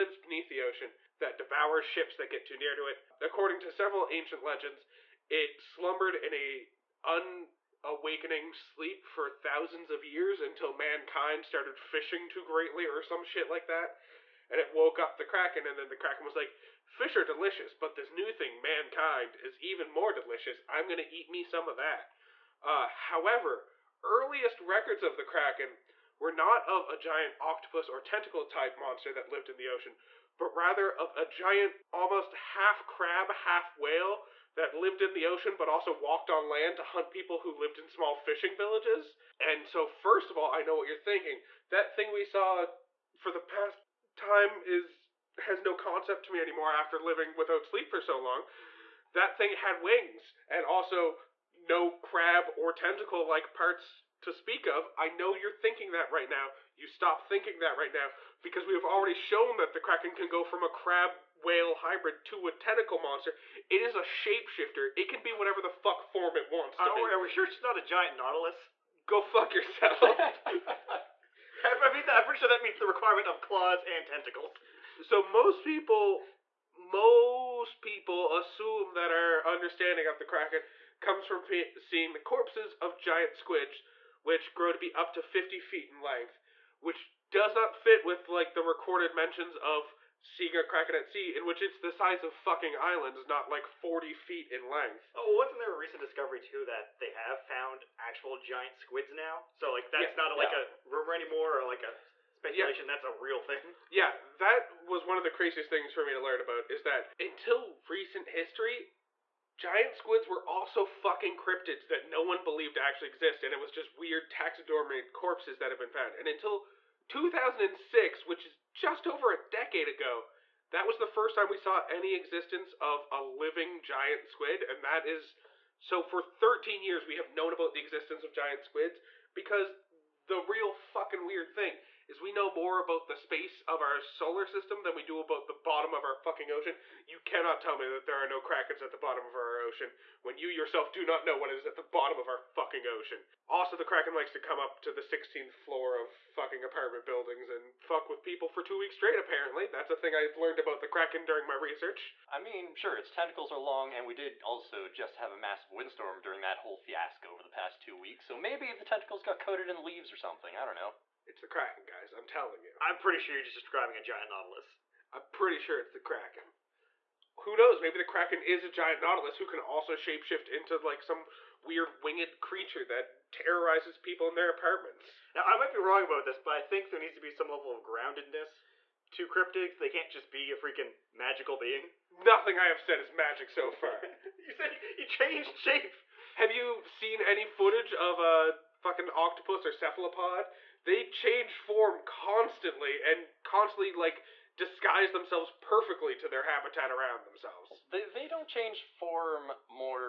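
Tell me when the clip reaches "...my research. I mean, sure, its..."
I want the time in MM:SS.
02:31.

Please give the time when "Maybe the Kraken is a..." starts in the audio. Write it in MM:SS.
02:47.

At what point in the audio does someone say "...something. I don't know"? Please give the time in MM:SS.
02:40.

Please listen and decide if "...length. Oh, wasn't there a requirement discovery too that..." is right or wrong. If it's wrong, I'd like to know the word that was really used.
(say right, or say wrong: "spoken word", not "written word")
wrong: "recent", not "requirement".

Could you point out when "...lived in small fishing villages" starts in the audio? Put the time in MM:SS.
00:37.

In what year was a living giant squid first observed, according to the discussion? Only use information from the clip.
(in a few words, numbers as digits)
2006.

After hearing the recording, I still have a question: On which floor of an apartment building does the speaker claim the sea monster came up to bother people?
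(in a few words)
16th floor.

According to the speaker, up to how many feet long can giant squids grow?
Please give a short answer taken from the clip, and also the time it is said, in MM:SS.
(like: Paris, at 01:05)
50, at 01:25.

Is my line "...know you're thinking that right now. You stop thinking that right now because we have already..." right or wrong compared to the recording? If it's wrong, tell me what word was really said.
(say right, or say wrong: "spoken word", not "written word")
right.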